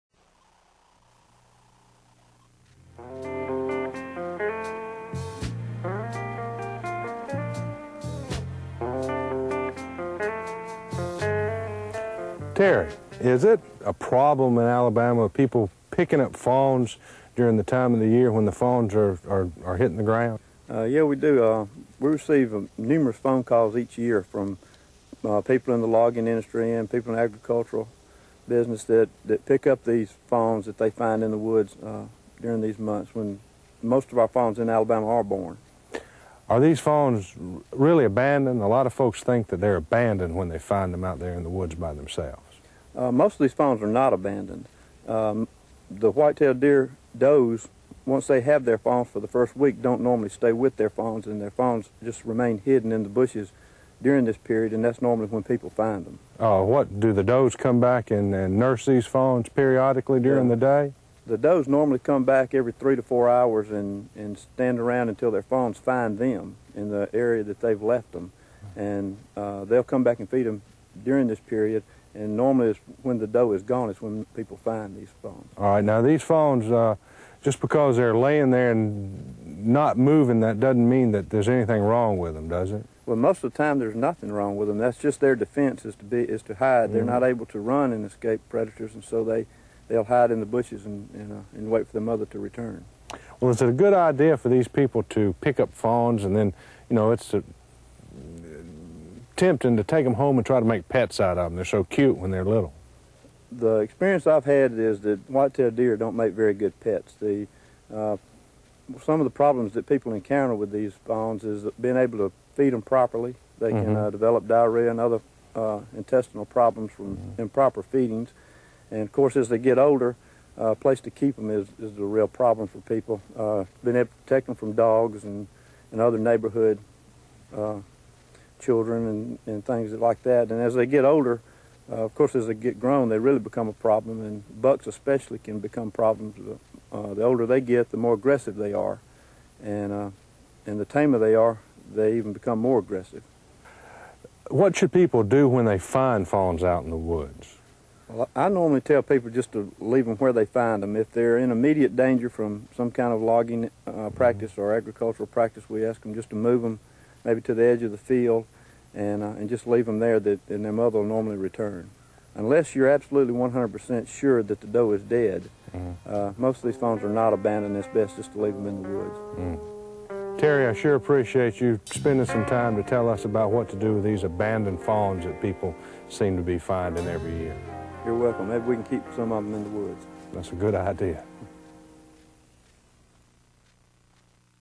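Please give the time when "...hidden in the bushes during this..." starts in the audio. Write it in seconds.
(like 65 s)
52 s.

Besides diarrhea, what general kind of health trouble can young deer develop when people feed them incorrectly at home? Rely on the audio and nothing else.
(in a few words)
intestinal problems.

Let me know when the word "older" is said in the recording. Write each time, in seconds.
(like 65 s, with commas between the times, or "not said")
119 s, 131 s, 137 s.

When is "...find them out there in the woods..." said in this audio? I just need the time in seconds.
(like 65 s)
40 s.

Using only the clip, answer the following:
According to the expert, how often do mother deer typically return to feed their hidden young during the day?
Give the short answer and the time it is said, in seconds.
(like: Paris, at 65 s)
every 3 to 4 hours, at 62 s.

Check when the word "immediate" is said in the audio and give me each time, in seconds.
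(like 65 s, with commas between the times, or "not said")
151 s.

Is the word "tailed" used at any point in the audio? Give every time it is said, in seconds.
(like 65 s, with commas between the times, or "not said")
46 s, 105 s.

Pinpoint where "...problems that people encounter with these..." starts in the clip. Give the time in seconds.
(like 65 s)
109 s.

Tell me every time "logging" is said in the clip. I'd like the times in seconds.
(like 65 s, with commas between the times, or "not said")
25 s, 153 s.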